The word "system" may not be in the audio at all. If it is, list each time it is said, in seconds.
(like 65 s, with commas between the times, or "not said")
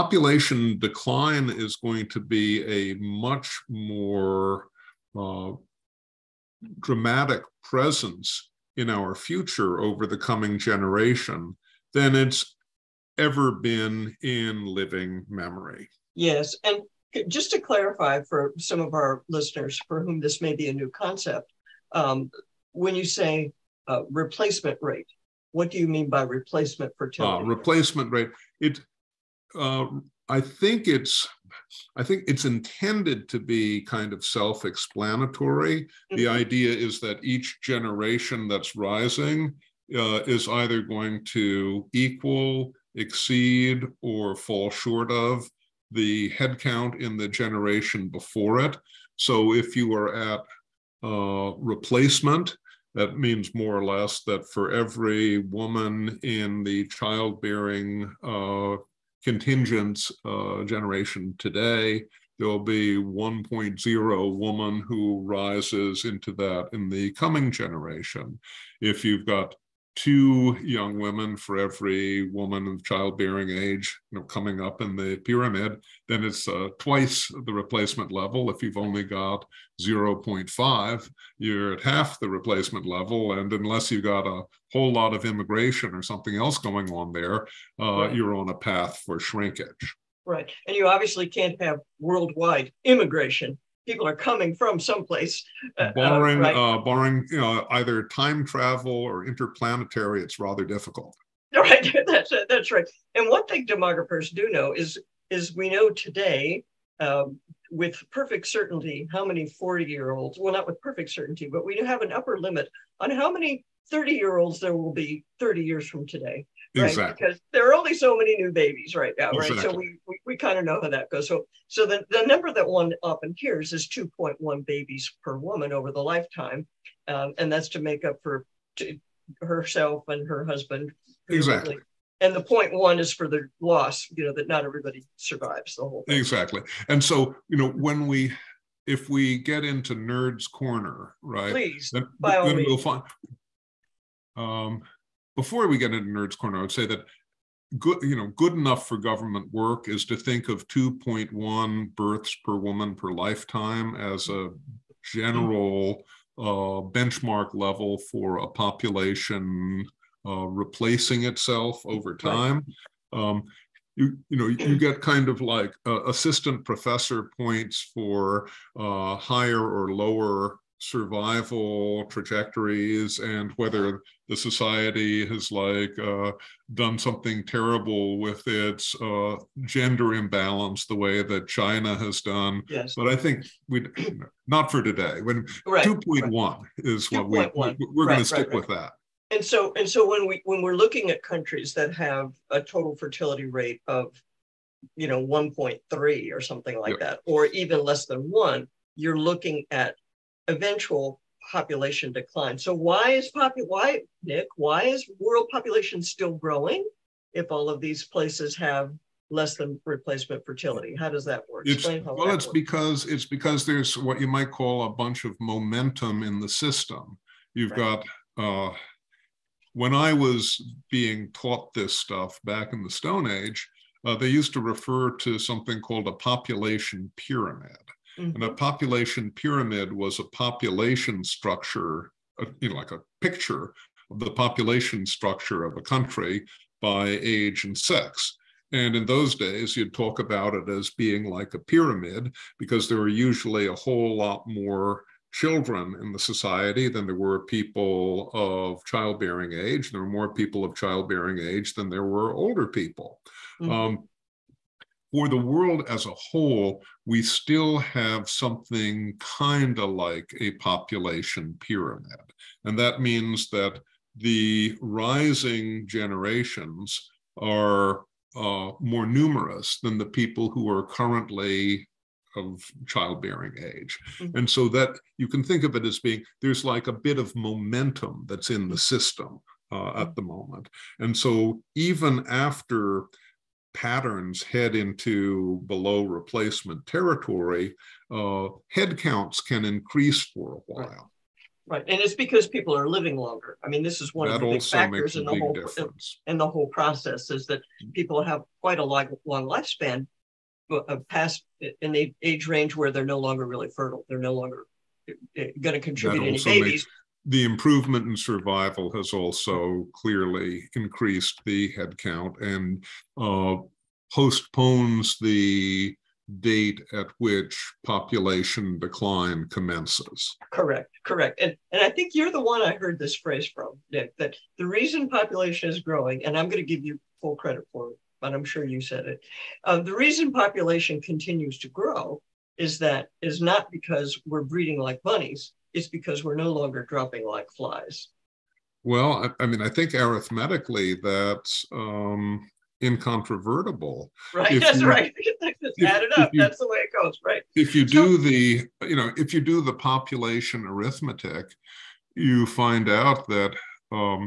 216 s, 278 s.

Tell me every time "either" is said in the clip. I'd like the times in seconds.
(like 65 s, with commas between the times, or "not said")
40 s, 97 s.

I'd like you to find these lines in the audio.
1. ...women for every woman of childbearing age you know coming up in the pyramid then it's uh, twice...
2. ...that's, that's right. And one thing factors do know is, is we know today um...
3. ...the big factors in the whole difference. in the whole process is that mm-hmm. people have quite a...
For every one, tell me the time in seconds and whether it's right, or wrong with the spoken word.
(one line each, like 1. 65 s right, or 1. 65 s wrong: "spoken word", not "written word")
1. 70 s right
2. 102 s wrong: "demographers", not "factors"
3. 294 s right.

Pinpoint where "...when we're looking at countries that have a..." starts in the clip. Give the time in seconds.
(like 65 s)
190 s.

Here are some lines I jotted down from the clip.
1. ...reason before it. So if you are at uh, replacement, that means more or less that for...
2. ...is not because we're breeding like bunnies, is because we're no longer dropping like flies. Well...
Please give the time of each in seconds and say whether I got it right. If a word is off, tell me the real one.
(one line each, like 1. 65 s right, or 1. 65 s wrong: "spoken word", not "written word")
1. 47 s wrong: "generation", not "reason"
2. 333 s right.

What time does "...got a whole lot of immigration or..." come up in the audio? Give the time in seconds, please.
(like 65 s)
84 s.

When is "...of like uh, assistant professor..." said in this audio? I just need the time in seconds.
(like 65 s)
165 s.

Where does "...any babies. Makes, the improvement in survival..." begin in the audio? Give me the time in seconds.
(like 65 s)
306 s.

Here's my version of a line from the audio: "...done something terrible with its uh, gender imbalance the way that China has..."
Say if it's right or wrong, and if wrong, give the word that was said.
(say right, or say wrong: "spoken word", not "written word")
right.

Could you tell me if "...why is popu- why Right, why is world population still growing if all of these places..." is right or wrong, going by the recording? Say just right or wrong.
wrong.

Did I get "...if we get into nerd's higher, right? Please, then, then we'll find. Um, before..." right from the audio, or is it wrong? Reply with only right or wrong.
wrong.